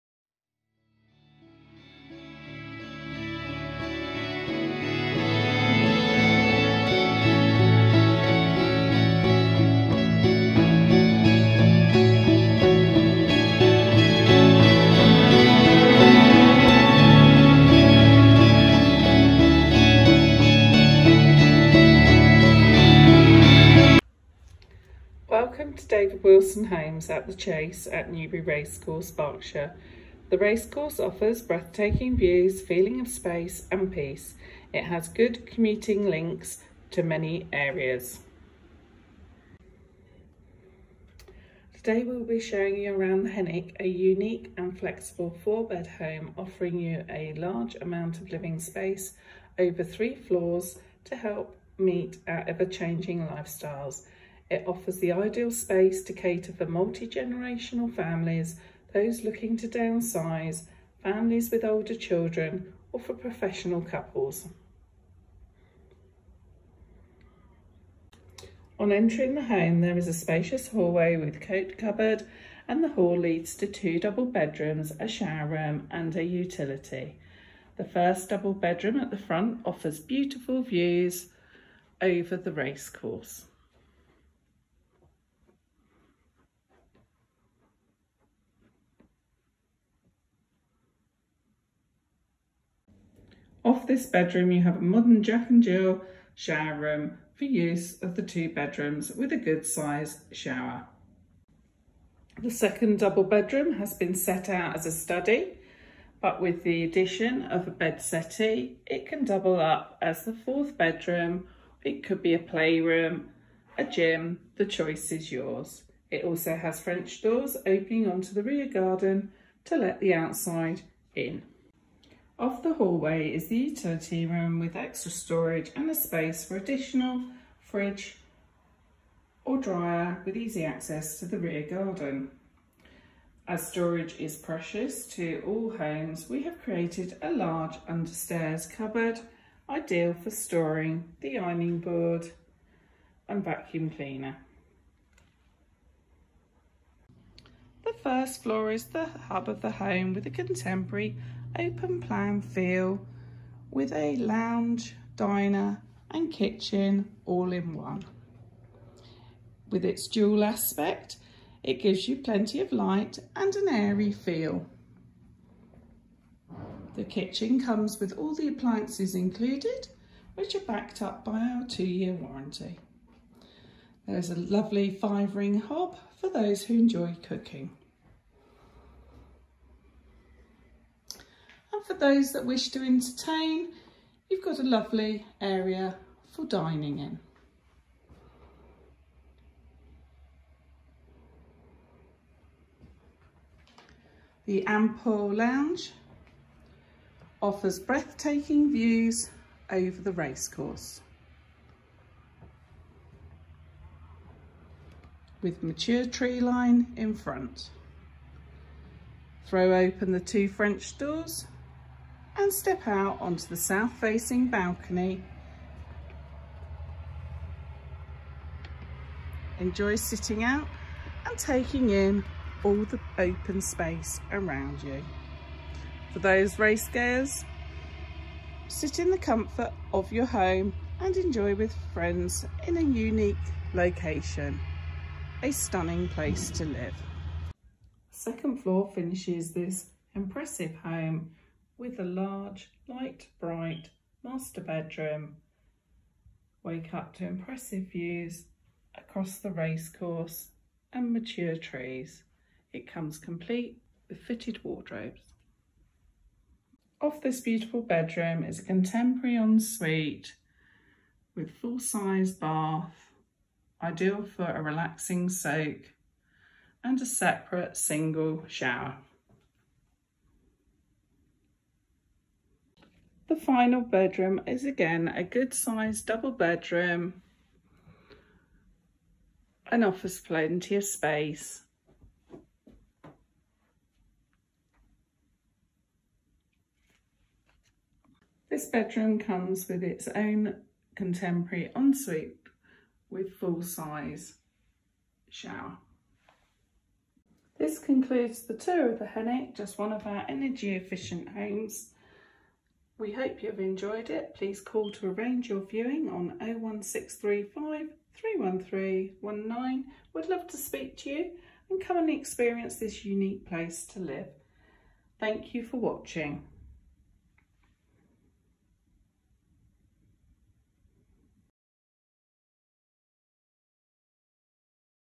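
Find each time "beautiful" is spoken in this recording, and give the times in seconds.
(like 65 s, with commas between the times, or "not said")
80 s, 257 s.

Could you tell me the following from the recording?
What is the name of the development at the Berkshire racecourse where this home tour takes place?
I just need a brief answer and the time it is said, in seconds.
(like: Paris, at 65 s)
The Chase, at 27 s.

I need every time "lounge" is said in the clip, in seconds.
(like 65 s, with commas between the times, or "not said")
154 s, 195 s.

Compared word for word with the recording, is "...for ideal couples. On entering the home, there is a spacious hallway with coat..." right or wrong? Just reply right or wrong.
wrong.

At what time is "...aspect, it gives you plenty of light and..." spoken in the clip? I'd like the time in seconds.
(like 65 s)
160 s.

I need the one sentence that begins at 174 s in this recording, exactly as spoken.
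There's a lovely five-ring hob for those who enjoy cooking.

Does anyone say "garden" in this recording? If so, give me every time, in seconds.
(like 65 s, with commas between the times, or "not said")
118 s, 131 s.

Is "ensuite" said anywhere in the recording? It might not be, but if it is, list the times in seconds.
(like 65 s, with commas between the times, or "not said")
259 s, 291 s.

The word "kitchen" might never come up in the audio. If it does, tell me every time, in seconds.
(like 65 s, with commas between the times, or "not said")
156 s, 167 s.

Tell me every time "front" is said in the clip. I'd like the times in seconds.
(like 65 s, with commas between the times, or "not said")
79 s, 207 s.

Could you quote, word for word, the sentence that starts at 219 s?
Enjoy sitting out and taking in all the open space around you.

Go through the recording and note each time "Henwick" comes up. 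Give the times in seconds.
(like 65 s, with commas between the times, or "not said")
43 s, 299 s.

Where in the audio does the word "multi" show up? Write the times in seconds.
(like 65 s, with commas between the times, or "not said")
56 s.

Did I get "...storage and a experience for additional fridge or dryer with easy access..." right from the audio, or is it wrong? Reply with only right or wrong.
wrong.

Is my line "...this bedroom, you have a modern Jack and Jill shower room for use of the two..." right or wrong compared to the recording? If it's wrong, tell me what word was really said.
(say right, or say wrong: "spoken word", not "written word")
right.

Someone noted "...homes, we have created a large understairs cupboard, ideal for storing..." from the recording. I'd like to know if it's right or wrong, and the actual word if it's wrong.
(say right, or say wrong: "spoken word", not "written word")
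right.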